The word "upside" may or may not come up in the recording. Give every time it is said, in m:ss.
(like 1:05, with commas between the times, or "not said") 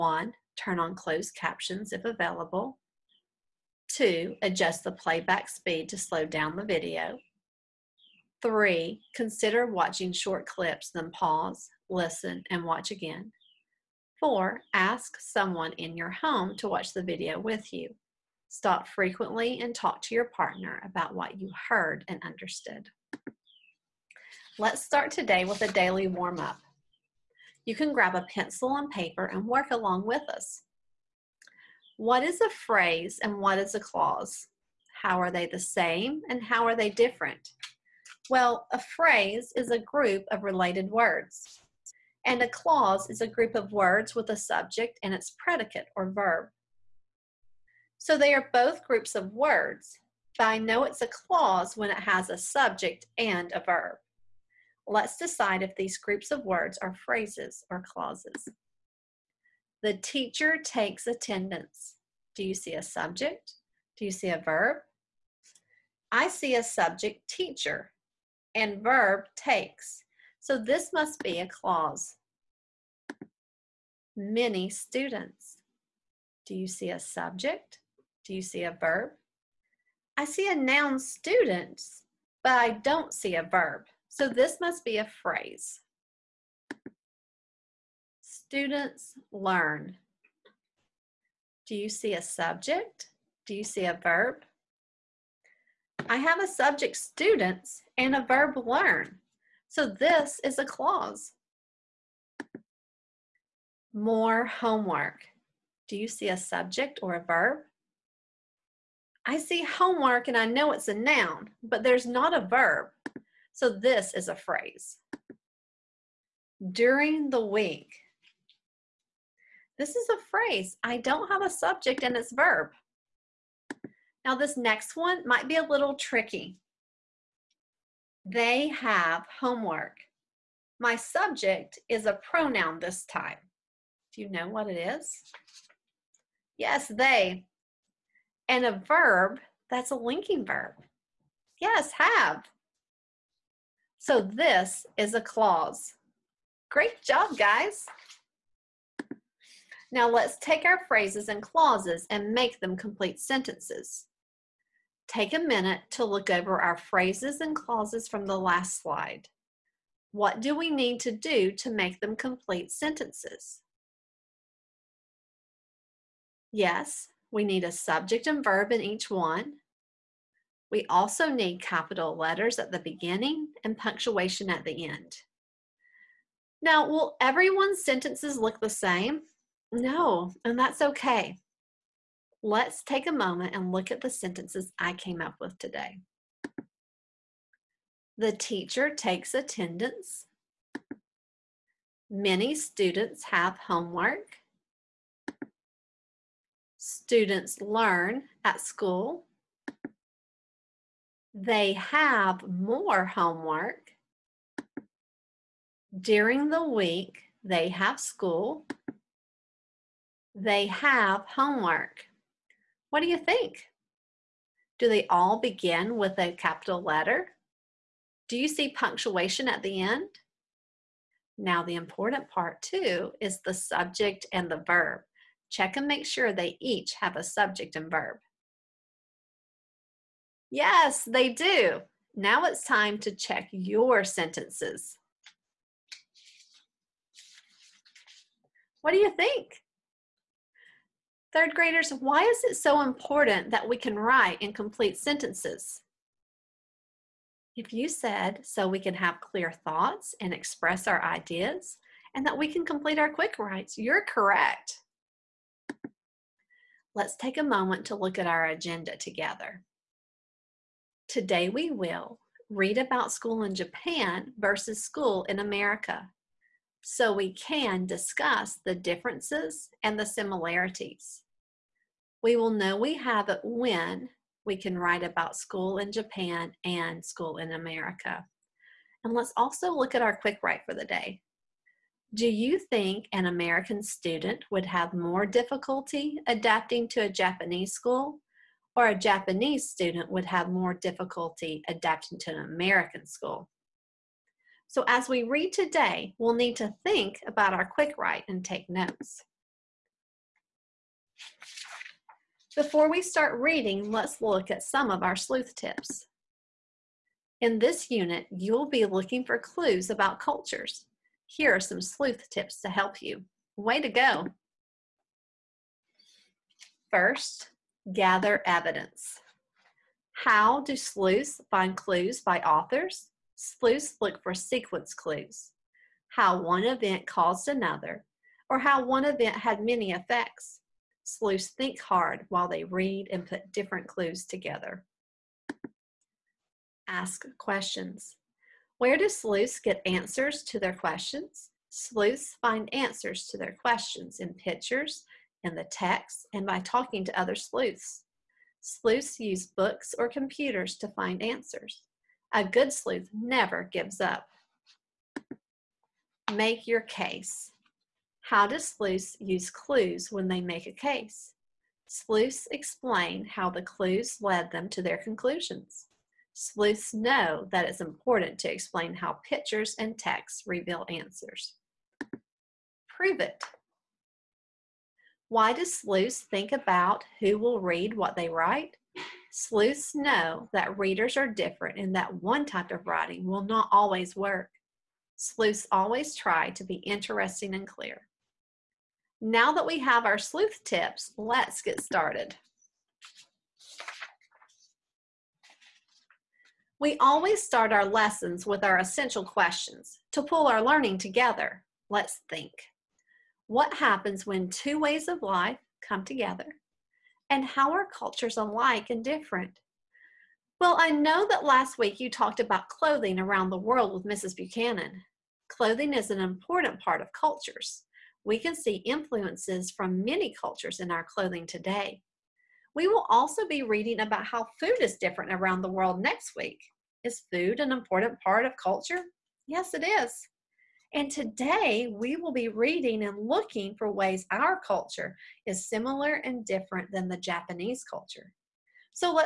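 not said.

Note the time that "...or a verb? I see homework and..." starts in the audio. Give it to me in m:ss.
1:47.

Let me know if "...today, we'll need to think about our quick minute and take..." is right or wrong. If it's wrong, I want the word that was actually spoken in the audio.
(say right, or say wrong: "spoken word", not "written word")
wrong: "write", not "minute".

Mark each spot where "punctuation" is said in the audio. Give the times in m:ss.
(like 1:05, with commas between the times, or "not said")
2:53, 3:38.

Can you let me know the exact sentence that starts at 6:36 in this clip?
We always start our lessons with our essential questions to pull our learning together.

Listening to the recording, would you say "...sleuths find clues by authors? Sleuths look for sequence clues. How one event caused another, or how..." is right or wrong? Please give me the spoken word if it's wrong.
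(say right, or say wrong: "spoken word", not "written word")
right.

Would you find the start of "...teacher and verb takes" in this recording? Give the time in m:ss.
1:07.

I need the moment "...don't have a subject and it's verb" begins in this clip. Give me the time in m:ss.
2:00.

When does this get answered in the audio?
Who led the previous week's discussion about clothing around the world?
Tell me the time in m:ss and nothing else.
6:54.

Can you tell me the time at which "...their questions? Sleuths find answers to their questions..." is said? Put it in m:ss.
5:40.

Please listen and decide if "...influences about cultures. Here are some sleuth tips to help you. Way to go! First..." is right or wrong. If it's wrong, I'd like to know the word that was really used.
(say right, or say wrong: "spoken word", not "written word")
wrong: "clues", not "influences".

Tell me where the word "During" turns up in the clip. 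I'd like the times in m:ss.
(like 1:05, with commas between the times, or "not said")
1:56, 3:25.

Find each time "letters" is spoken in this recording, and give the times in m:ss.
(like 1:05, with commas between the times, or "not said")
2:52, 3:36.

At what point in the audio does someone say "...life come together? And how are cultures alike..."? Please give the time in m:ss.
6:45.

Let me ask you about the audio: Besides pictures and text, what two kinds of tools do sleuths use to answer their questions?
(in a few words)
books or computers.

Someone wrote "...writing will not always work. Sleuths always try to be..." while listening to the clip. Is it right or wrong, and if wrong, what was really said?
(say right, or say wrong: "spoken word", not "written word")
right.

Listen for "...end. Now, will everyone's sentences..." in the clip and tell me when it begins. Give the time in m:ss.
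2:54.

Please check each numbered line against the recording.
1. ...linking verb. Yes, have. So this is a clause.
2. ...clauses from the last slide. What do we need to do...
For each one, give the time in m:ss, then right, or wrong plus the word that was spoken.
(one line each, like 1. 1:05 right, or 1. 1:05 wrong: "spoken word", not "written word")
1. 2:19 right
2. 2:37 right.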